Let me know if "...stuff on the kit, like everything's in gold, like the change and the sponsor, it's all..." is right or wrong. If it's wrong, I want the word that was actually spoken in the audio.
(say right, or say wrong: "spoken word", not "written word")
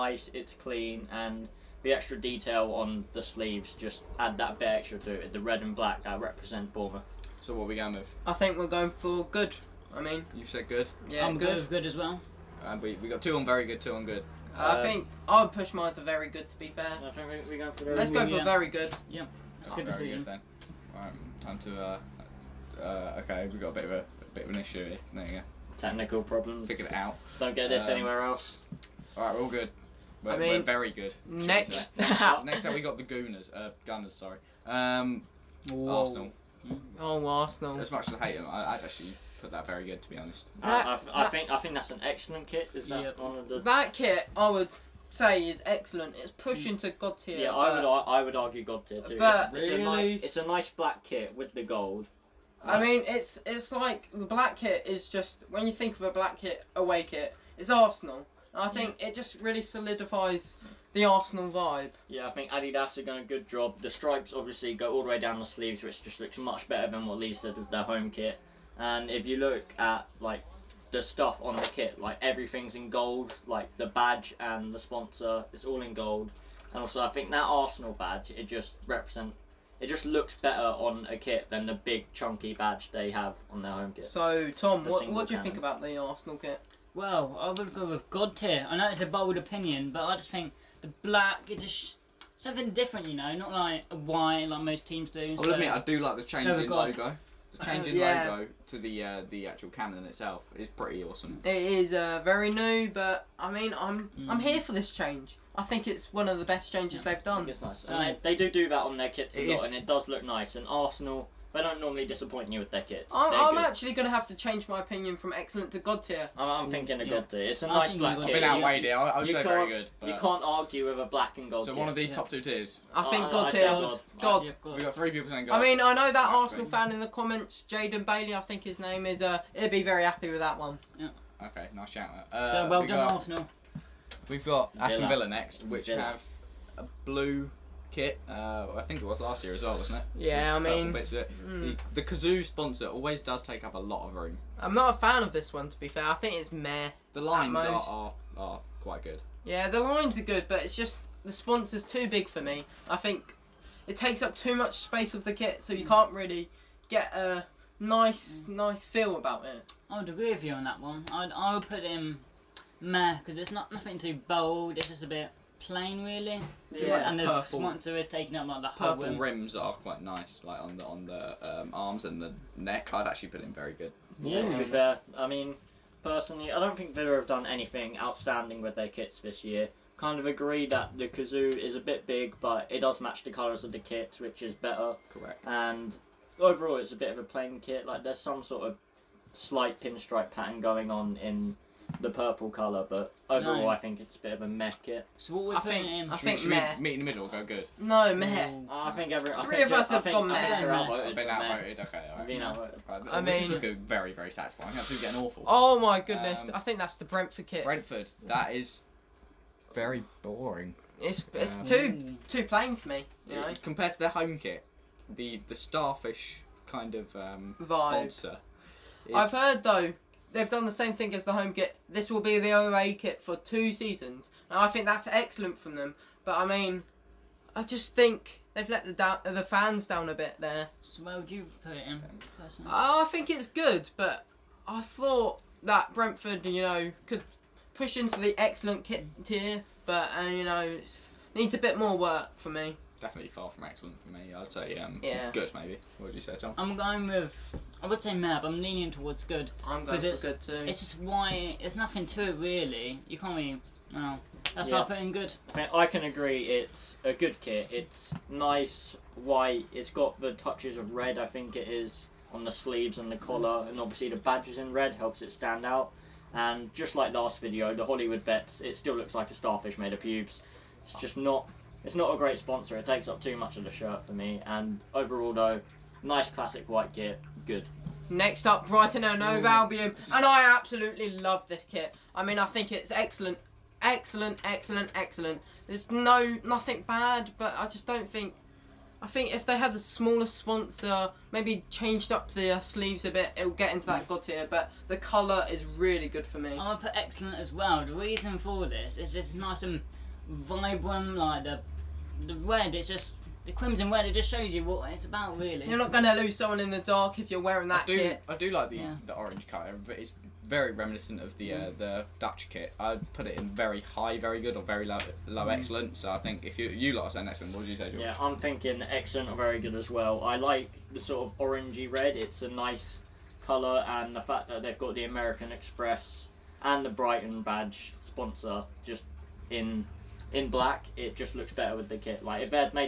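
wrong: "badge", not "change".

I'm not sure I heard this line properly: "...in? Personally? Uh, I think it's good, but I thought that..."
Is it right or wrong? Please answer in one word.
right.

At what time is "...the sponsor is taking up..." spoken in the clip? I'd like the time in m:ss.
2:47.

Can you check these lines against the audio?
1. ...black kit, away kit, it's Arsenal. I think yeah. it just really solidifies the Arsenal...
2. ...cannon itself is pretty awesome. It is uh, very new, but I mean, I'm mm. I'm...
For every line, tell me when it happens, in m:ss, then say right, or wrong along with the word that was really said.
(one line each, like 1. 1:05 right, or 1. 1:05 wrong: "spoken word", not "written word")
1. 0:56 right
2. 1:39 right.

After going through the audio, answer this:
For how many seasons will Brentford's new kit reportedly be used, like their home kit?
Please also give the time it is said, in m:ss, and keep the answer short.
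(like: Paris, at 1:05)
2, at 3:43.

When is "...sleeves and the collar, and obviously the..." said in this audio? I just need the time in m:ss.
4:22.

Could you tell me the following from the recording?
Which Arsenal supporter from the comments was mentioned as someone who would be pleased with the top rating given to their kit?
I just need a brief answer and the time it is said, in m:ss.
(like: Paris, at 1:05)
Jaden Bailey, at 2:07.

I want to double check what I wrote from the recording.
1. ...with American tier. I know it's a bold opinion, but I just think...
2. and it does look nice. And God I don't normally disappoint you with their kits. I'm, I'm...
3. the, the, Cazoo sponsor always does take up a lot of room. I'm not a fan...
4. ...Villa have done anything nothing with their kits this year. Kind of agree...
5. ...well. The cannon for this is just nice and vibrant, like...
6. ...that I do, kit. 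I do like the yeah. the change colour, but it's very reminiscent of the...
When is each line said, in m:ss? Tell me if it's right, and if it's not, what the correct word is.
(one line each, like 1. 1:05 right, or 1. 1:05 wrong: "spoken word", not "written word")
1. 1:27 wrong: "God", not "American"
2. 1:49 wrong: "Arsenal", not "God"
3. 2:21 right
4. 2:56 wrong: "outstanding", not "nothing"
5. 4:57 wrong: "reason", not "cannon"
6. 5:07 wrong: "orange", not "change".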